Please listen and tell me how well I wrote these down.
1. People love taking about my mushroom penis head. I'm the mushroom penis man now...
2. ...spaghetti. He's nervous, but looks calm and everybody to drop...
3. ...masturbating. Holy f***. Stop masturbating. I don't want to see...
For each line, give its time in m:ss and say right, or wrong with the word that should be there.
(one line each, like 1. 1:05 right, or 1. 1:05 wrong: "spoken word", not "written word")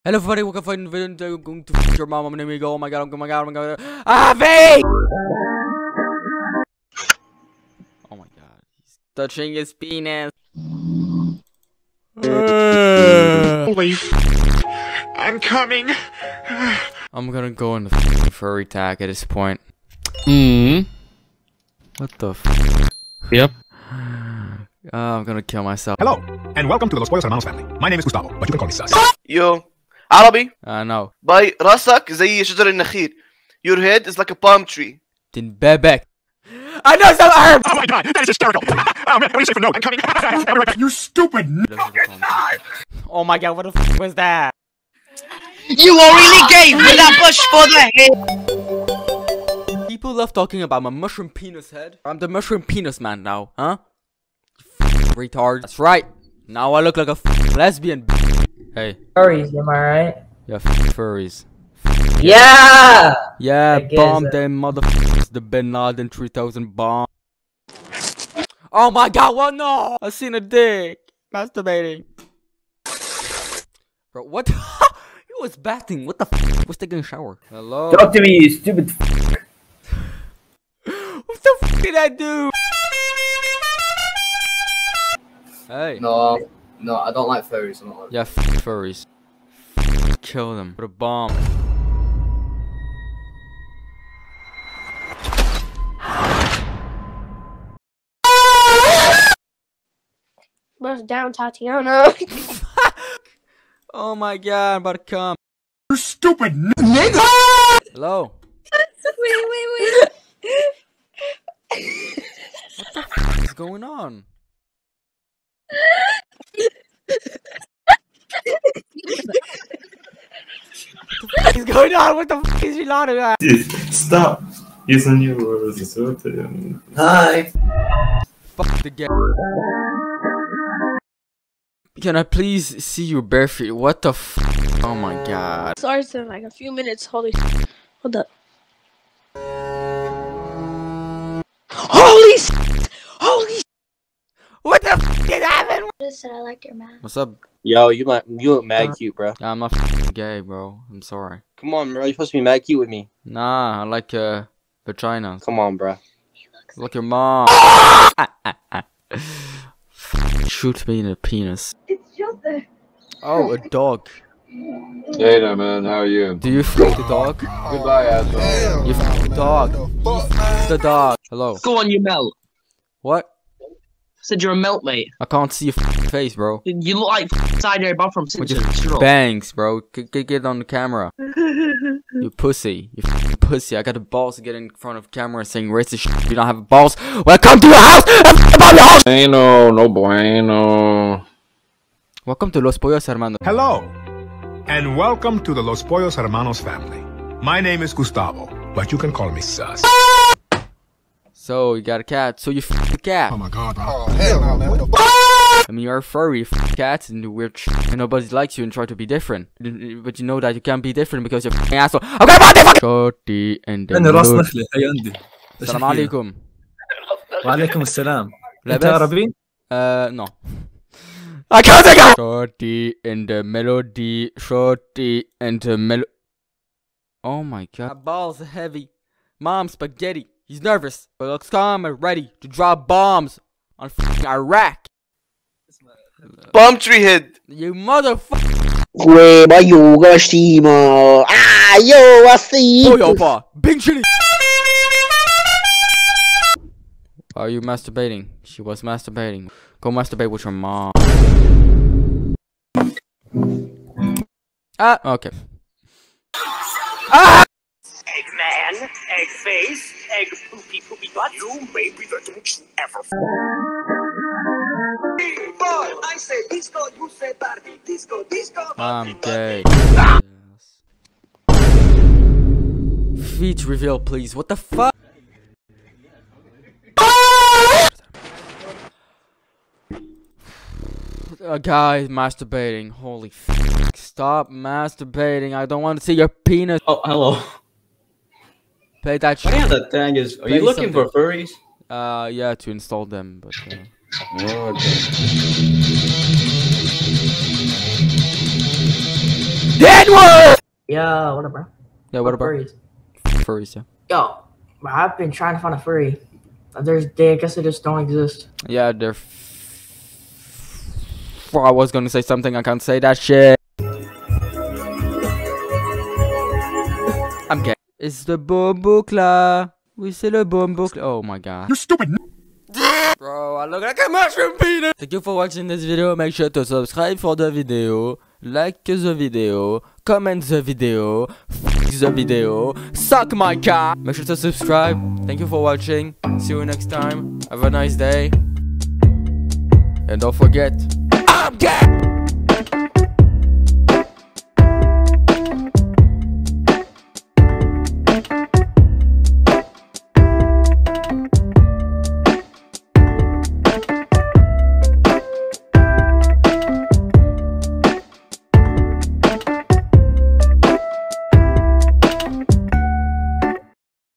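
1. 0:49 wrong: "talking", not "taking"
2. 3:49 wrong: "ready", not "everybody"
3. 4:42 right.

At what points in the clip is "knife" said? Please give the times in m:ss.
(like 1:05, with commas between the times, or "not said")
0:42.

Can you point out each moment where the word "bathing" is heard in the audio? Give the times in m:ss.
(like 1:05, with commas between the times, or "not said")
1:15.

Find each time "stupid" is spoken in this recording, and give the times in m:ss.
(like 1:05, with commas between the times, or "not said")
0:41, 1:18, 1:45, 5:21.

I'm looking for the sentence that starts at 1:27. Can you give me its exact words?
I'm not like yeah, f furries.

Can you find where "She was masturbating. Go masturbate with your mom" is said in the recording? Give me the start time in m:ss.
4:08.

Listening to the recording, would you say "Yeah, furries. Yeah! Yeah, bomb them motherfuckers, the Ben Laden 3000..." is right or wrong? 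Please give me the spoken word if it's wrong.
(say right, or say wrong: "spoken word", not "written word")
right.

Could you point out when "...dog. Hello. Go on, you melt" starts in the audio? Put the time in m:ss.
2:50.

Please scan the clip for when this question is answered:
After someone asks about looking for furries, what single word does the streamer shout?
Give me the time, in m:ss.
4:59.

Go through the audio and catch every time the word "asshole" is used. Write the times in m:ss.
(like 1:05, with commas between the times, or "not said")
2:48, 3:31.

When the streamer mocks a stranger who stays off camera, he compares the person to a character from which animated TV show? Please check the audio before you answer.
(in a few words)
Simpsons.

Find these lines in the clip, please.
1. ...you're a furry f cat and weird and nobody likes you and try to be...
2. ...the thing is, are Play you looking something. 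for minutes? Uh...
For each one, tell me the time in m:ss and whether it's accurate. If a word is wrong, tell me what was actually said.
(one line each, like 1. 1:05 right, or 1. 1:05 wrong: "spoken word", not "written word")
1. 3:25 right
2. 4:49 wrong: "furries", not "minutes".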